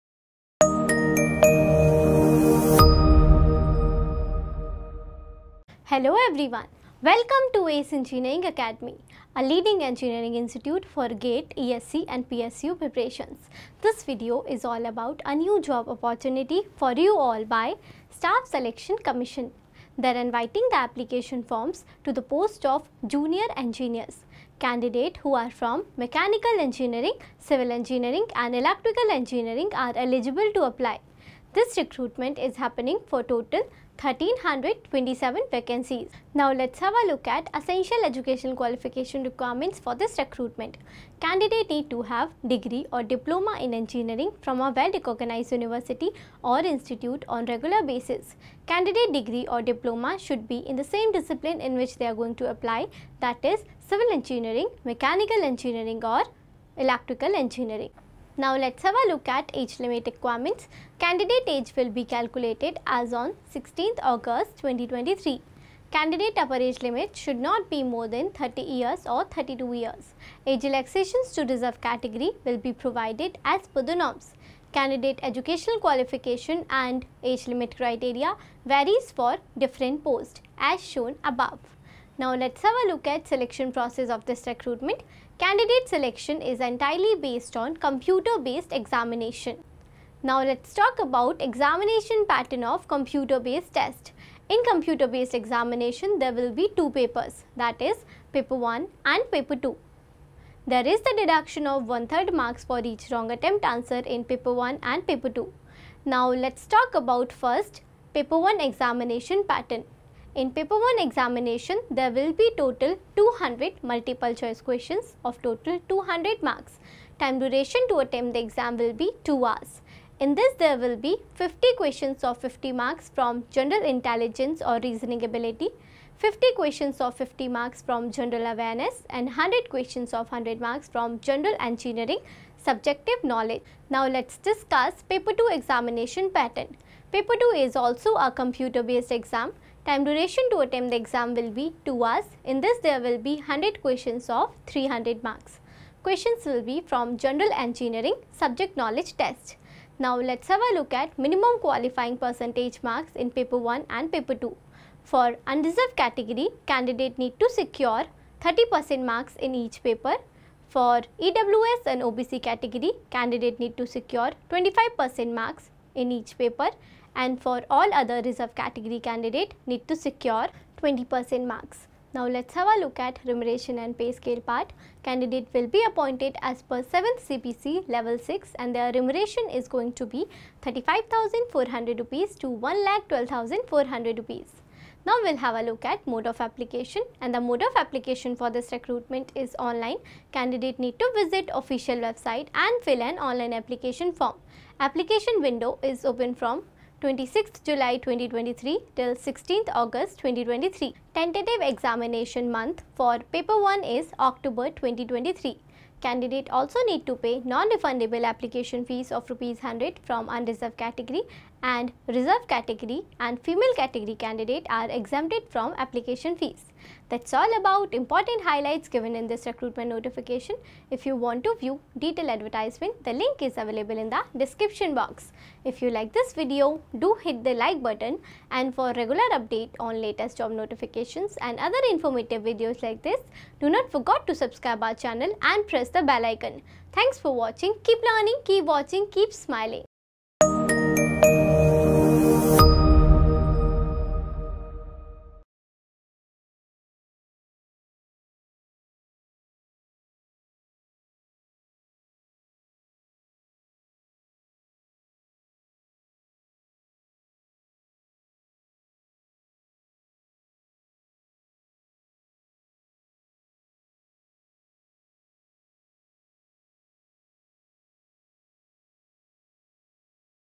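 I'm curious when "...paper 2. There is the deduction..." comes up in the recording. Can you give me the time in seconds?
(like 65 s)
99 s.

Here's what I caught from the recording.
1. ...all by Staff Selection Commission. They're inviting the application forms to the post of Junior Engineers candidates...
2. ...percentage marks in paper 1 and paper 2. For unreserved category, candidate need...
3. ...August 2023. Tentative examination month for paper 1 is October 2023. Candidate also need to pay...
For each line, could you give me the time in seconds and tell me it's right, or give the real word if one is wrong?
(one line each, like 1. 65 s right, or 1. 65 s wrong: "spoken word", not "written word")
1. 17 s right
2. 152 s right
3. 199 s right.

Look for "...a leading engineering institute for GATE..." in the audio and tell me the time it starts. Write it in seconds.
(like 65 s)
9 s.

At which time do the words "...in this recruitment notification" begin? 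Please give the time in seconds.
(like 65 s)
219 s.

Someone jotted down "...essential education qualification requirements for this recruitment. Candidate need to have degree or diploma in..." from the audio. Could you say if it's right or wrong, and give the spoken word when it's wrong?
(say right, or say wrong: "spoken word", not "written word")
right.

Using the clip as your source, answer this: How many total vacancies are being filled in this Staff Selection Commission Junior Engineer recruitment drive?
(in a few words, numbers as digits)
1327.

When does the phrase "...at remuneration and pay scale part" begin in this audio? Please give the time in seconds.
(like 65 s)
172 s.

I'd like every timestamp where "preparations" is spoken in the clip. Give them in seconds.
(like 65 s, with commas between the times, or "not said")
12 s.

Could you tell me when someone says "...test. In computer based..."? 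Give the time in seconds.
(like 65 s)
93 s.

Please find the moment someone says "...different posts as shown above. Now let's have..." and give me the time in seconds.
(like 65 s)
79 s.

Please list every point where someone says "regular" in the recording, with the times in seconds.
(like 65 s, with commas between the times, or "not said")
47 s, 228 s.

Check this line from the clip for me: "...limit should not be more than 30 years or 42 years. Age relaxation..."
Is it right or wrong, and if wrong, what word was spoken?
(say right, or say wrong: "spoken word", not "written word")
wrong: "32", not "42".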